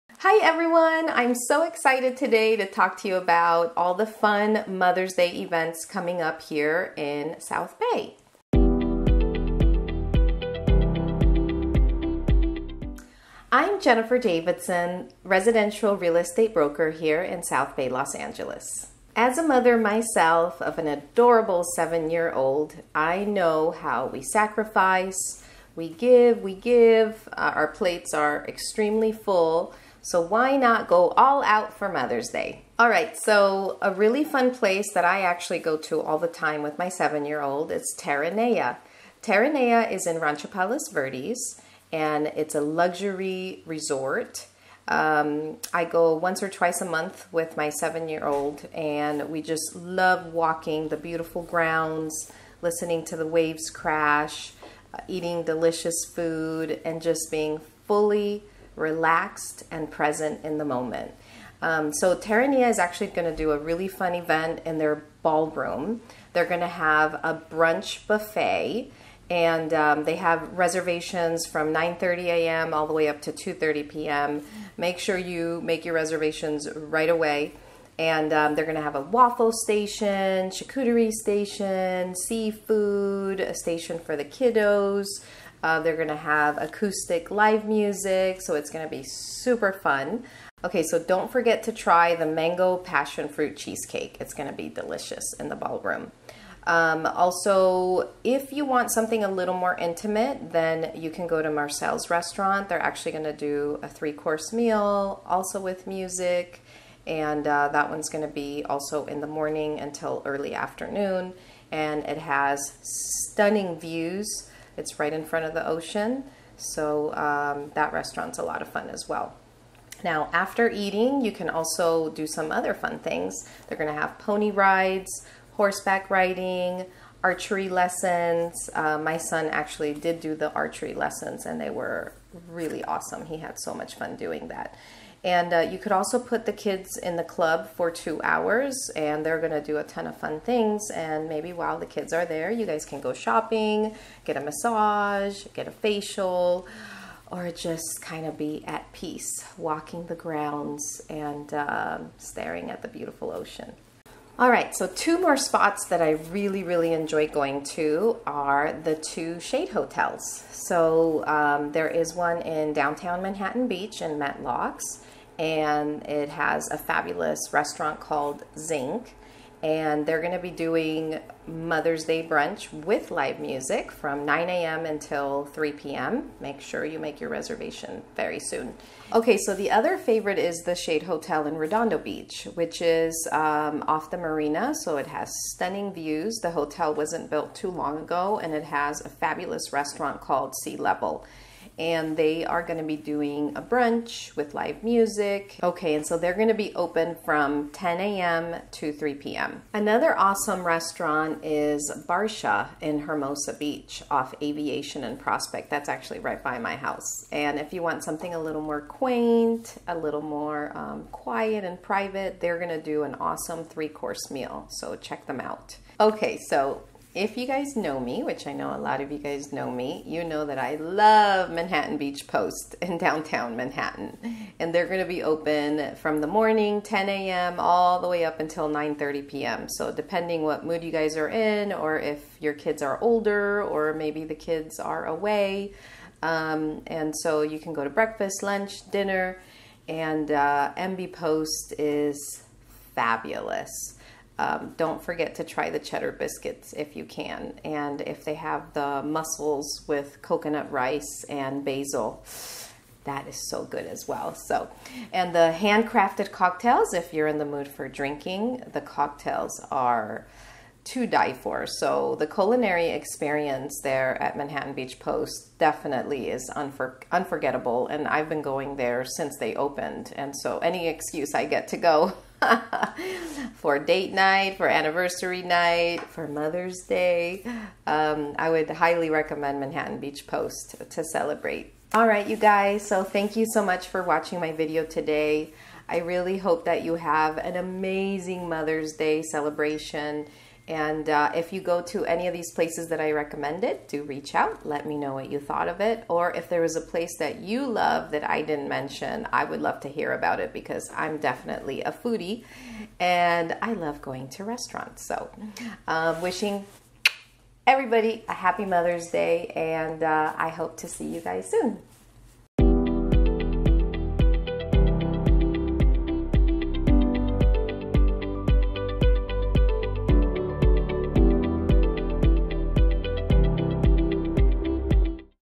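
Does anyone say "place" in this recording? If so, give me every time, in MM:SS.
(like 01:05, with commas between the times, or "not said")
00:34, 04:52, 04:56.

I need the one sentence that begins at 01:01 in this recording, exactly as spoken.
Um, so Terranea is actually going to do a really fun event in their ballroom.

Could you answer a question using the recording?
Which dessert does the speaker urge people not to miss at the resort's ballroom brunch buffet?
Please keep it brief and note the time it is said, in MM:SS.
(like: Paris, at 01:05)
Mango passion fruit cheesecake, at 01:32.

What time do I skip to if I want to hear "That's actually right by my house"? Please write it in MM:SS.
03:25.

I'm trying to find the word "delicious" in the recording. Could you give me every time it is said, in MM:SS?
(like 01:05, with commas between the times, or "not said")
00:55, 01:34.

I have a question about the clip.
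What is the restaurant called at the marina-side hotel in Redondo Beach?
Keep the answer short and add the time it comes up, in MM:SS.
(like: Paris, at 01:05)
Sea Level, at 03:10.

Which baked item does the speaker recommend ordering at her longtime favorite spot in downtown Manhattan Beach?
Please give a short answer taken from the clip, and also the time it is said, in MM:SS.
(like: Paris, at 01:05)
Cheddar biscuits, at 04:05.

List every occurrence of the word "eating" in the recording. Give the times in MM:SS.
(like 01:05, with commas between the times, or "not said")
00:55, 02:00.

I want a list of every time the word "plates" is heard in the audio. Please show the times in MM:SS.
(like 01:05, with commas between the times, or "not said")
00:27.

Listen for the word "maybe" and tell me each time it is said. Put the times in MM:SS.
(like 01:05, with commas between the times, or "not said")
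02:21, 03:53.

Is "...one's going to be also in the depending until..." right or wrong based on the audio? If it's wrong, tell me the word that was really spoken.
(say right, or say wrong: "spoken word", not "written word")
wrong: "morning", not "depending".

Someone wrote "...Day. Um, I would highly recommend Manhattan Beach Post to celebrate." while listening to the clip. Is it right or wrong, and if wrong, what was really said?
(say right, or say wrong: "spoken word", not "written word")
right.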